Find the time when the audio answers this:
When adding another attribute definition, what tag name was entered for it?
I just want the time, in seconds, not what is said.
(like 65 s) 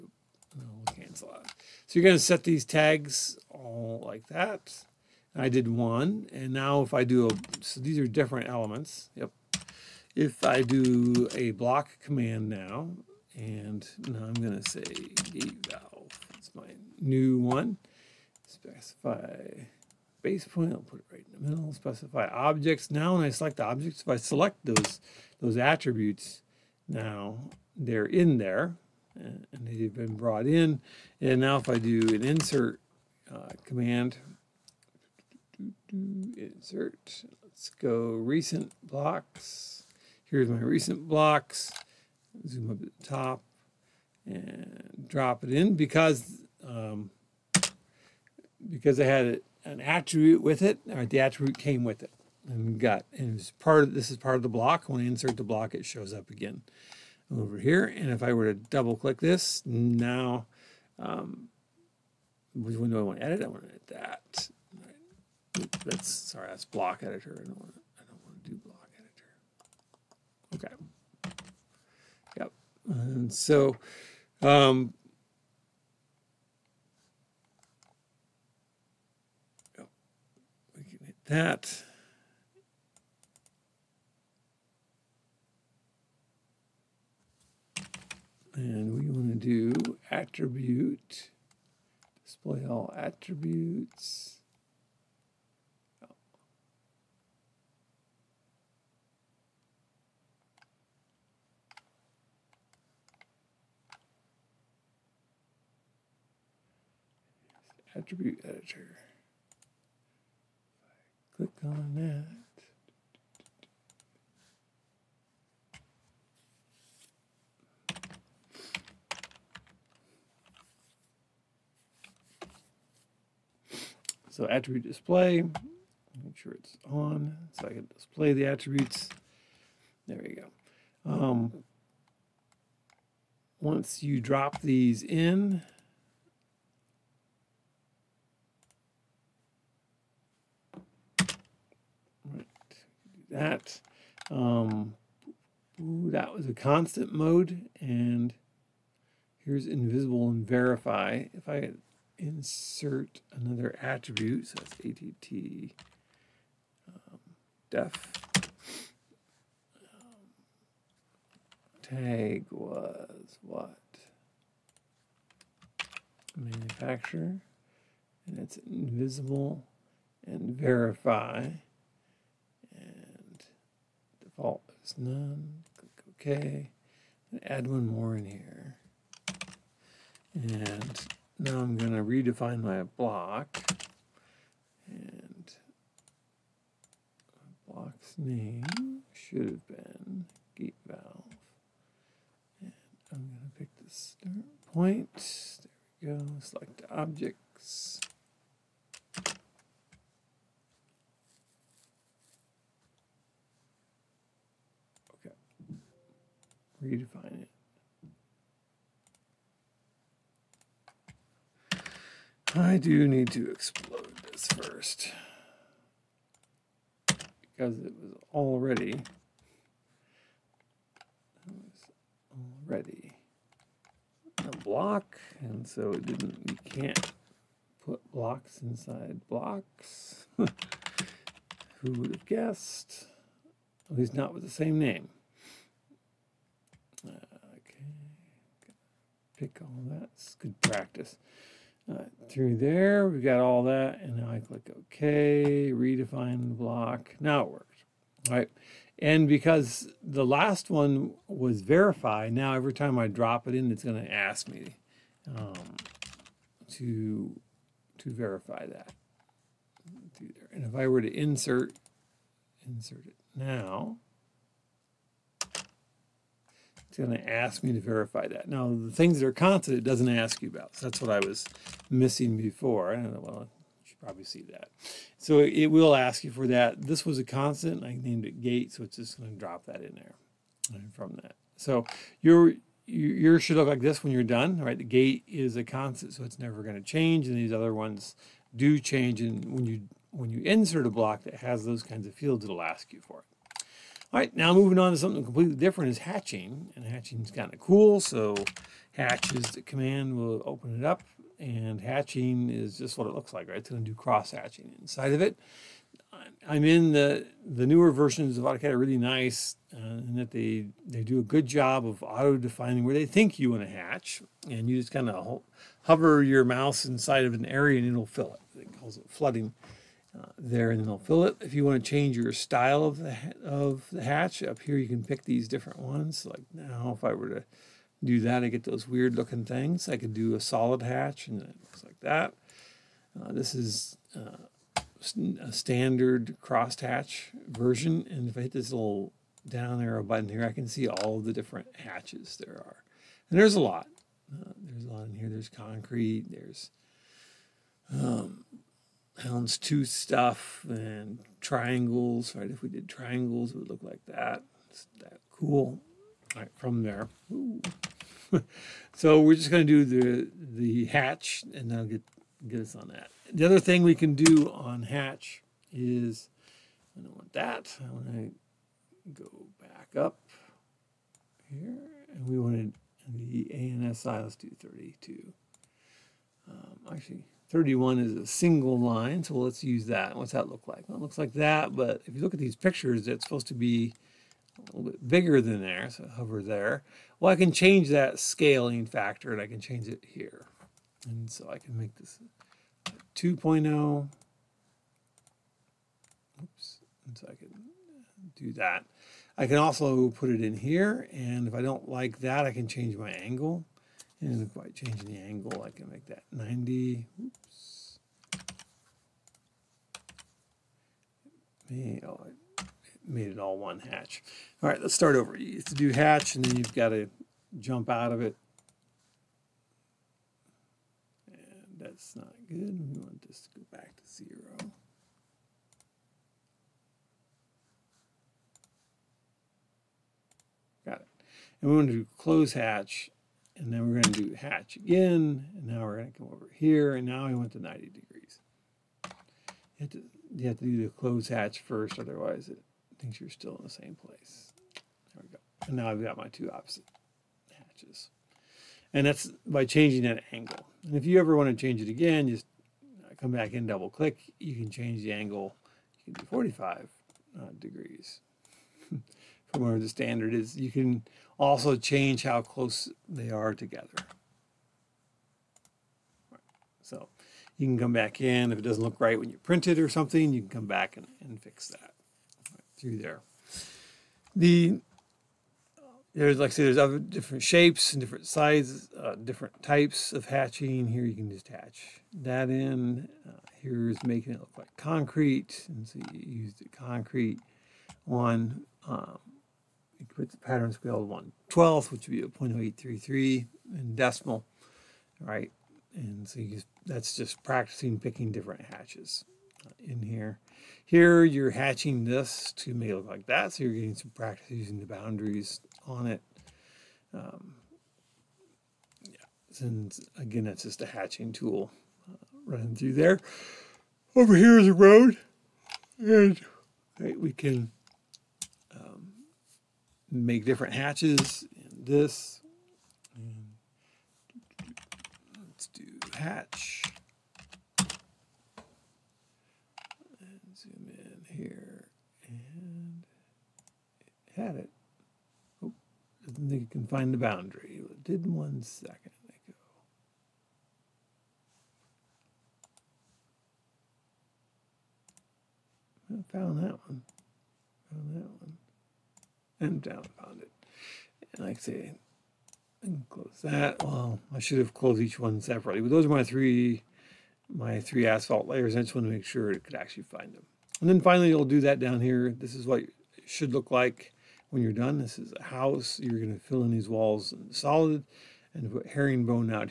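166 s.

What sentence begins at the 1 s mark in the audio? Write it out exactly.
So you're going to set these tags like that.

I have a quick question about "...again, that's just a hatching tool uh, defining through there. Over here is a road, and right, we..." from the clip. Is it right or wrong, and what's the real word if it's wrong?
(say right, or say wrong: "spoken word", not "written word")
wrong: "running", not "defining".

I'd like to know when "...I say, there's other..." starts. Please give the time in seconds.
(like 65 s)
476 s.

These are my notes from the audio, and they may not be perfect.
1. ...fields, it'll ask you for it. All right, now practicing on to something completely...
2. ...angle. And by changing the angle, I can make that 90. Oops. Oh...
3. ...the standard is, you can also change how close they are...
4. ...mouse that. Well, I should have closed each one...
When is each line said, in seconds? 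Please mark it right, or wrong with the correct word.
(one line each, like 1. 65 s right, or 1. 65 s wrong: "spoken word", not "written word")
1. 292 s wrong: "moving", not "practicing"
2. 403 s right
3. 459 s right
4. 553 s wrong: "close", not "mouse".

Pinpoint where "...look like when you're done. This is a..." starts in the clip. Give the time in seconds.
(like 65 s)
563 s.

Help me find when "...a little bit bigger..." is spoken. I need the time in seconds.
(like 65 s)
384 s.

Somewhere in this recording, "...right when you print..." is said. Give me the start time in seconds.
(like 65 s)
468 s.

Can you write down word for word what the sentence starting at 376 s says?
Um, actually, 31 is a single line, so let's use that.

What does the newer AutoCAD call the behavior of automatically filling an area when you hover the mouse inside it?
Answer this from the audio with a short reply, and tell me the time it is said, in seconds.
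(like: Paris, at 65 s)
flooding, at 319 s.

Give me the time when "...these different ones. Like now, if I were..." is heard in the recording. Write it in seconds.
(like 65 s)
325 s.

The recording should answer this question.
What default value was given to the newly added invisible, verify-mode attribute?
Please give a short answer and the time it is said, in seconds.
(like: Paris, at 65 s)
none, at 174 s.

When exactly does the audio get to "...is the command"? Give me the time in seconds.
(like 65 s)
299 s.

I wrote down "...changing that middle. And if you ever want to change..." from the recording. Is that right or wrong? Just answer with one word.
wrong.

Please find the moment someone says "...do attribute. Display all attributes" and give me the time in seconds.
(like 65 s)
89 s.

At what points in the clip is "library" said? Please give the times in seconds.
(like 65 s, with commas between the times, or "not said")
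not said.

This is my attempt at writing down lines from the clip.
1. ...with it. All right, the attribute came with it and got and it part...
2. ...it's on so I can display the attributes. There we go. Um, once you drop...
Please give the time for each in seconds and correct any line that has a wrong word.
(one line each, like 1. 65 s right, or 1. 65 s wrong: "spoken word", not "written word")
1. 50 s right
2. 126 s right.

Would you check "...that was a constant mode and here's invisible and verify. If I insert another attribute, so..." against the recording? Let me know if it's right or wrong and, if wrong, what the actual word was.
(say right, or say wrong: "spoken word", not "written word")
right.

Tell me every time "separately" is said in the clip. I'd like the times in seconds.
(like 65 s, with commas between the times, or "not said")
555 s.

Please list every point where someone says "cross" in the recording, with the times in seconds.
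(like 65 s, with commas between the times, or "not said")
303 s.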